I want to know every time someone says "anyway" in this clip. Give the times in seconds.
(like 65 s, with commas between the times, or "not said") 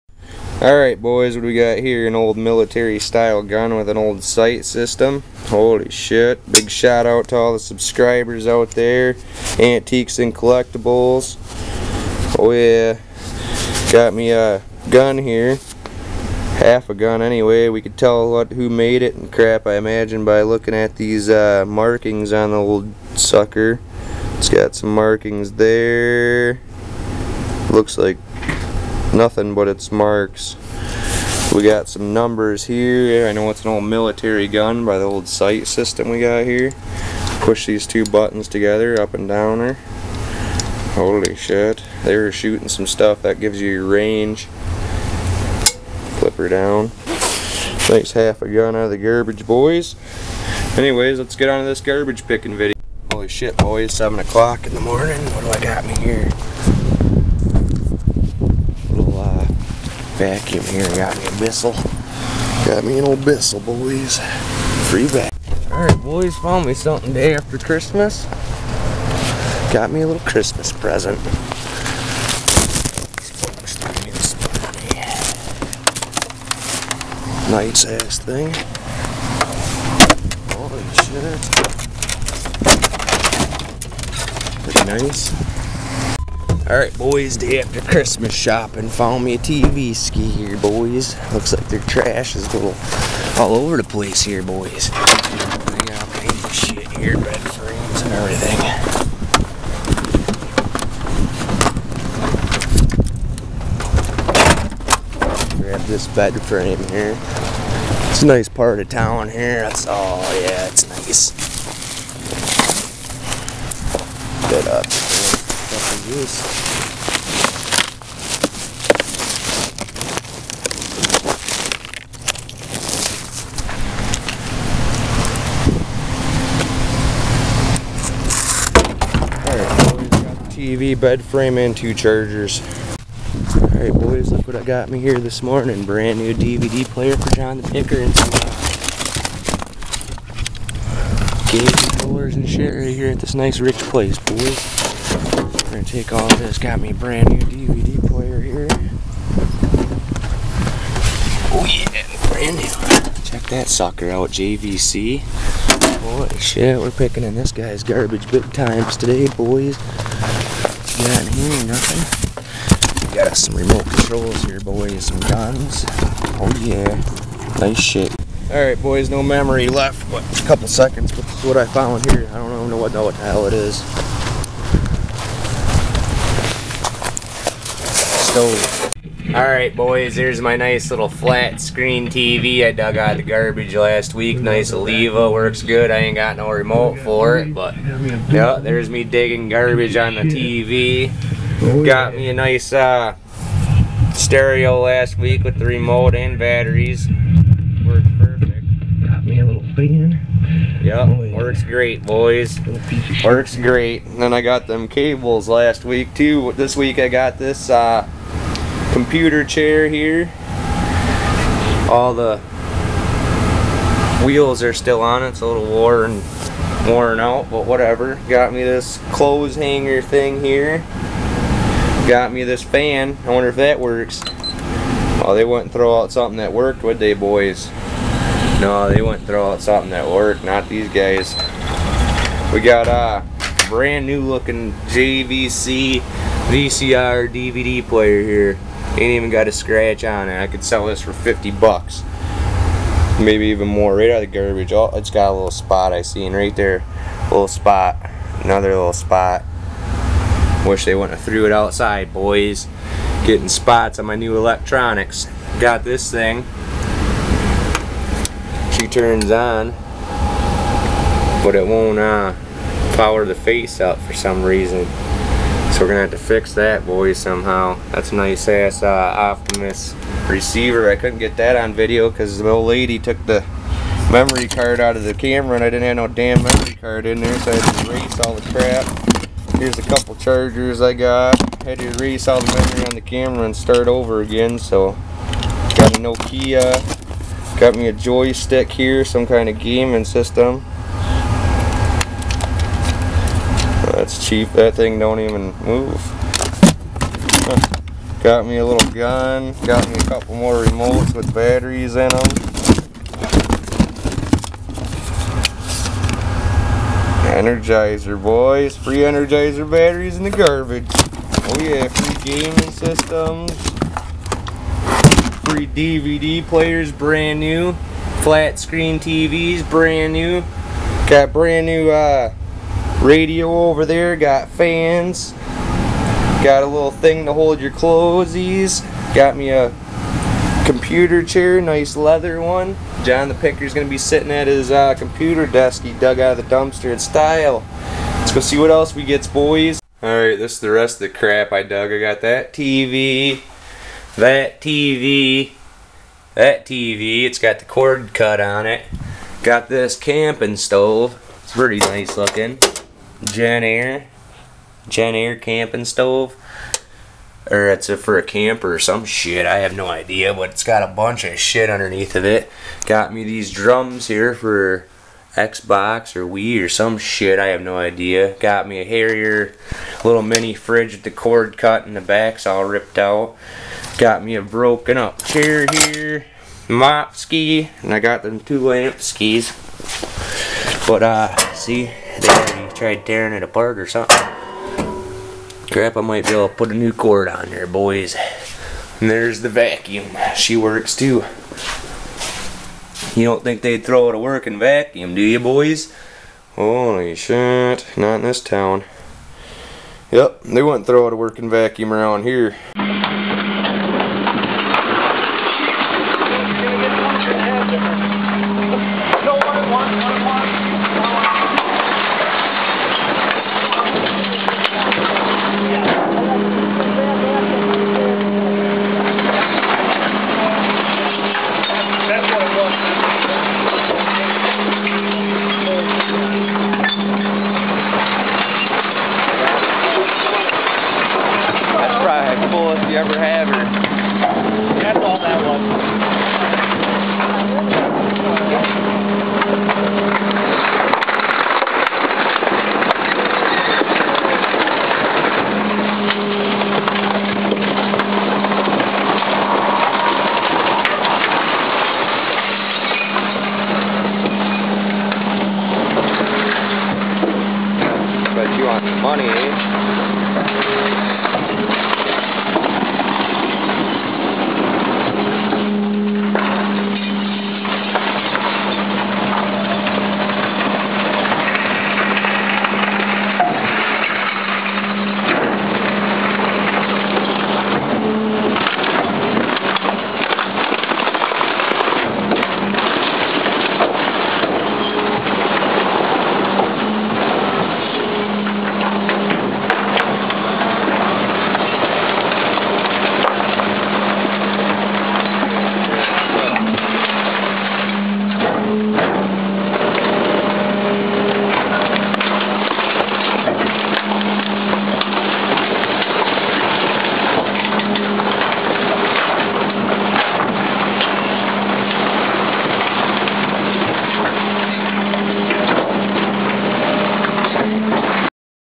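17 s, 50 s.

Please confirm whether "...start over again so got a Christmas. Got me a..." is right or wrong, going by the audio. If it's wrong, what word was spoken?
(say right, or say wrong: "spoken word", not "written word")
wrong: "Nokia", not "Christmas".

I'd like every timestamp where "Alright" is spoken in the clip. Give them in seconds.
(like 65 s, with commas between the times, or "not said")
0 s, 65 s, 86 s, 133 s, 168 s, 179 s, 340 s.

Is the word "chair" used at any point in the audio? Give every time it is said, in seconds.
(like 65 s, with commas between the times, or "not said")
209 s, 331 s, 375 s.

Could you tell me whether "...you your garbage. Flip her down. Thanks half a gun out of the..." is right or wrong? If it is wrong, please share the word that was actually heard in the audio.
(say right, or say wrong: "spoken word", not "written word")
wrong: "range", not "garbage".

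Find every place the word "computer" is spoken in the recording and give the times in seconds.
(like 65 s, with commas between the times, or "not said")
209 s, 330 s, 334 s.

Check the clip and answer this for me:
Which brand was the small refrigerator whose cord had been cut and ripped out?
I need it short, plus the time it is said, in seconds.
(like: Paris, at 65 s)
Haier, at 368 s.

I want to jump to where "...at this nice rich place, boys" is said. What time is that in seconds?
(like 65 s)
143 s.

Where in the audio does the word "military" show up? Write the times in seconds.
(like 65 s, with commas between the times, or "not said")
2 s, 33 s.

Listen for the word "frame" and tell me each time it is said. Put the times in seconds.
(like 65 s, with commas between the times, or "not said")
97 s, 106 s, 131 s.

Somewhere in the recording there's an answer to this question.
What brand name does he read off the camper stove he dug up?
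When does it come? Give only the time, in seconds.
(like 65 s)
353 s.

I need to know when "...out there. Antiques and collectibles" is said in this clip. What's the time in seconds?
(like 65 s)
8 s.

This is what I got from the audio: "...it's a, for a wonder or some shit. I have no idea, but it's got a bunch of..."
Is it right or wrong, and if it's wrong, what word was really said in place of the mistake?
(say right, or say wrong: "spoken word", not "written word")
wrong: "camper", not "wonder".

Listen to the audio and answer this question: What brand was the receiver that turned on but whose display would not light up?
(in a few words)
Optimus.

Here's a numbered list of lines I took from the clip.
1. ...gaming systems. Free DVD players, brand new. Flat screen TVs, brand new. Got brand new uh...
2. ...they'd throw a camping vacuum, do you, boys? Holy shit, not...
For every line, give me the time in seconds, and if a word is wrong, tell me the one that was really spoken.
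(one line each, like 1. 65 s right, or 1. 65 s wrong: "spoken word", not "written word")
1. 312 s right
2. 393 s wrong: "working", not "camping".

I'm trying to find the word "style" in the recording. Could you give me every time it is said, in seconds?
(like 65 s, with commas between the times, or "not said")
2 s, 336 s.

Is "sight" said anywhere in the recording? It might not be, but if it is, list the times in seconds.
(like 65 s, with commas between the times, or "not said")
4 s, 35 s.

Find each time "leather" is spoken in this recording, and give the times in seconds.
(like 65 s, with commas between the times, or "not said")
331 s.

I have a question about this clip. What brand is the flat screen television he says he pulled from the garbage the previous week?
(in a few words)
Olevia.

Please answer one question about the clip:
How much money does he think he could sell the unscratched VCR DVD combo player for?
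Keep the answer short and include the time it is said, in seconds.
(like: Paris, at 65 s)
50 bucks, at 241 s.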